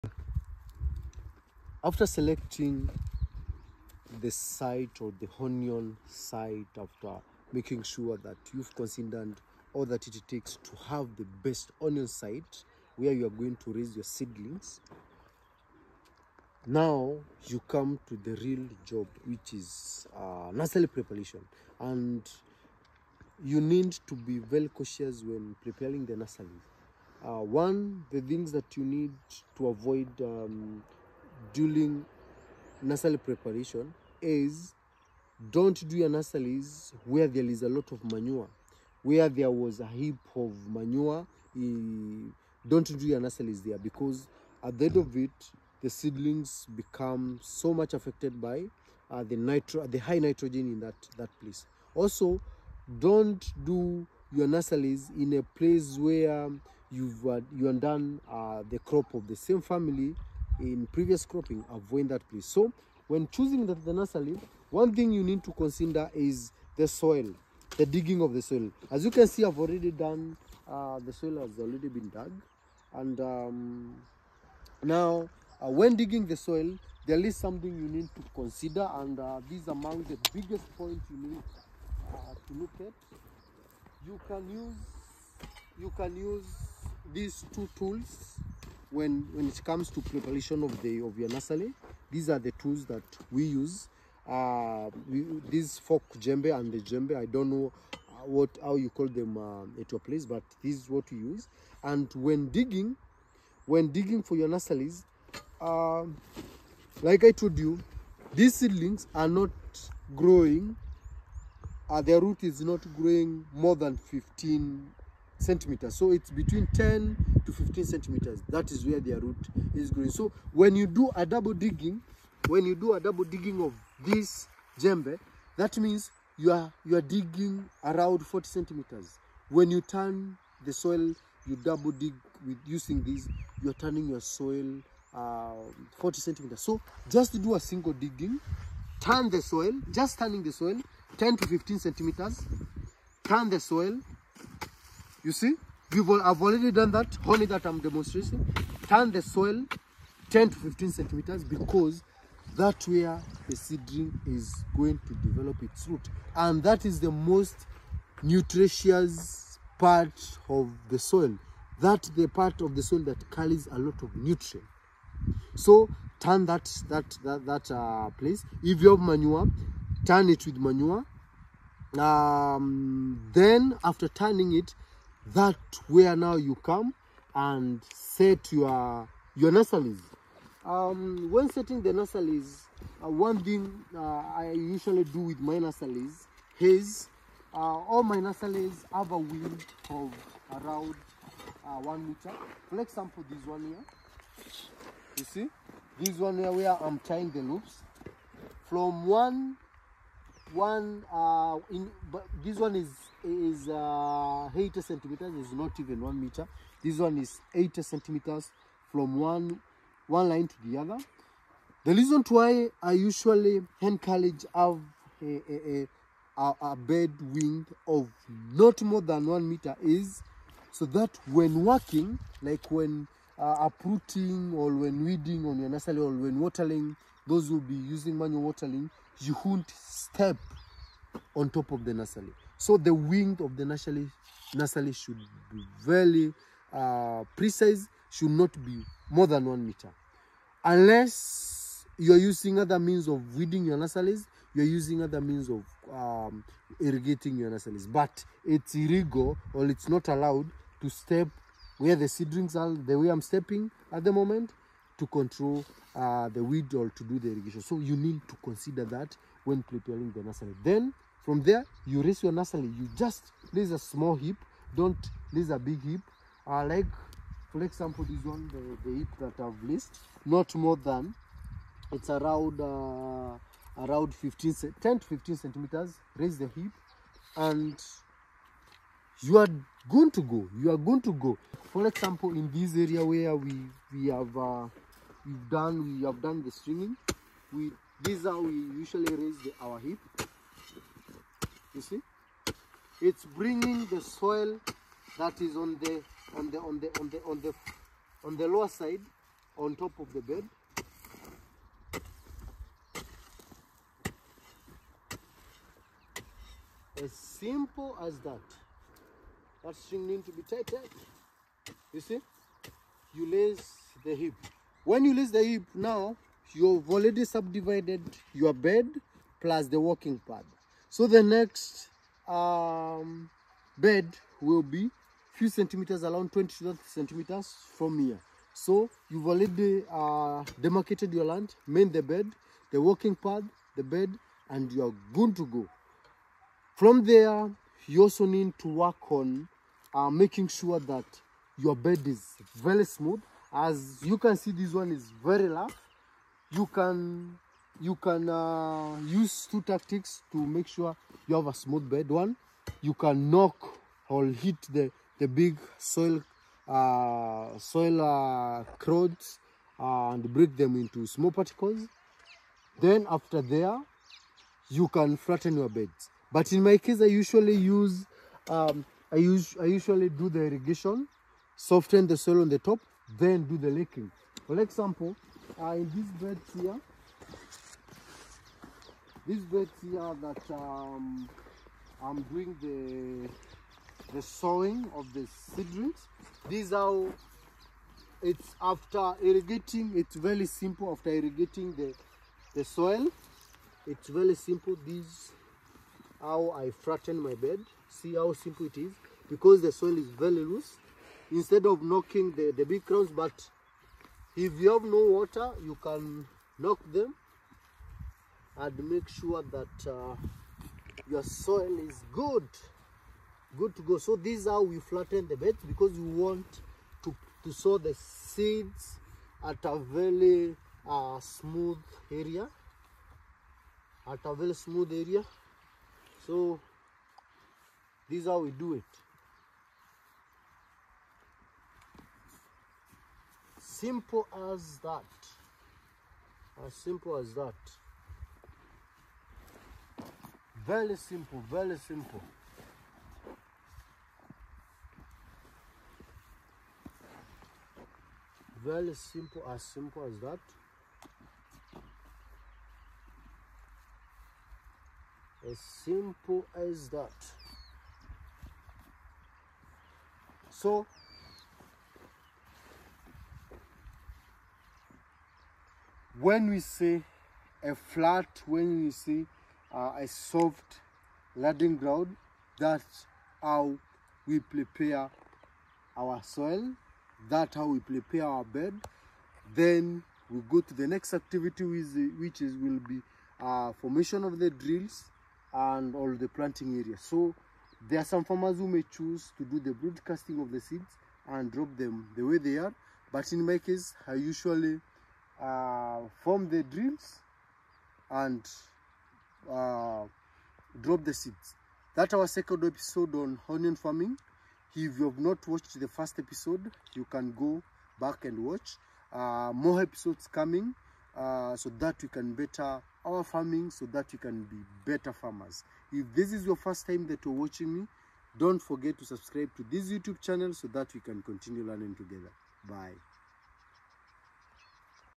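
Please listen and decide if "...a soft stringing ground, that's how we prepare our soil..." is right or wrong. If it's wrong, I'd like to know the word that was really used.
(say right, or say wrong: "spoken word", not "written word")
wrong: "landing", not "stringing".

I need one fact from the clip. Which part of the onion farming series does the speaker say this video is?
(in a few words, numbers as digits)
second.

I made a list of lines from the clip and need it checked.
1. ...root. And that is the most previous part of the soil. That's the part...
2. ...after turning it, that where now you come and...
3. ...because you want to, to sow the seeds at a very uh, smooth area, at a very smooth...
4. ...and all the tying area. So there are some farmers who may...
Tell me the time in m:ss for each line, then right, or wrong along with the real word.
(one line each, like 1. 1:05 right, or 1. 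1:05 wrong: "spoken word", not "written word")
1. 2:35 wrong: "nutritious", not "previous"
2. 2:53 right
3. 6:55 right
4. 8:05 wrong: "planting", not "tying".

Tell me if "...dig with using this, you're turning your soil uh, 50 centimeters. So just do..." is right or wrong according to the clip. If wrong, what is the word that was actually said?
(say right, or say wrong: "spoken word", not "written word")
wrong: "40", not "50".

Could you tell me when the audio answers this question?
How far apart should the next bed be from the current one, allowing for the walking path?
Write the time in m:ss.
5:26.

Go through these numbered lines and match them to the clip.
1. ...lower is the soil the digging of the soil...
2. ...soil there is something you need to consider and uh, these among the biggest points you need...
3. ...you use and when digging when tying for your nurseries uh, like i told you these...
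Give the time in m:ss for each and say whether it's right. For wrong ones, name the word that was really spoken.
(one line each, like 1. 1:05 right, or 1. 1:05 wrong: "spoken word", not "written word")
1. 1:05 wrong: "consider", not "lower"
2. 1:16 right
3. 1:41 wrong: "digging", not "tying".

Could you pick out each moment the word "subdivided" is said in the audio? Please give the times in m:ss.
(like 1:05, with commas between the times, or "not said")
5:17.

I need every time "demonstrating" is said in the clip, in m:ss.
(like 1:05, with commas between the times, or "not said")
2:27.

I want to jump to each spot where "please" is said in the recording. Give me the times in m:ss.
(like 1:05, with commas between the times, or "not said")
1:02.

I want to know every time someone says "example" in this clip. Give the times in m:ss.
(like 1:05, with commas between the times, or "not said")
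3:12, 4:27, 4:41, 6:14.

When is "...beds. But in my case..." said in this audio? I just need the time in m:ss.
6:05.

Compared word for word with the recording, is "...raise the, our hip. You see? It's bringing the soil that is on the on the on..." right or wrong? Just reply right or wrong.
right.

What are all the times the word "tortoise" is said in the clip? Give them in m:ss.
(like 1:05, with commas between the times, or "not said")
not said.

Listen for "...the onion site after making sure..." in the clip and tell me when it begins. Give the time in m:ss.
0:05.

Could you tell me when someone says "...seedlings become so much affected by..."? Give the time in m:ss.
0:45.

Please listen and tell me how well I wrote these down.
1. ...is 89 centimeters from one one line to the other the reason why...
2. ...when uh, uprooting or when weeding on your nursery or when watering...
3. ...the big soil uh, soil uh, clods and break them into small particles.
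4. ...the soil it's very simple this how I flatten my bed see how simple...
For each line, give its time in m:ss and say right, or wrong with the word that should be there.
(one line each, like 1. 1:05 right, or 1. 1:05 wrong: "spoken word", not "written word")
1. 3:27 wrong: "80", not "89"
2. 3:42 right
3. 5:55 right
4. 6:32 right.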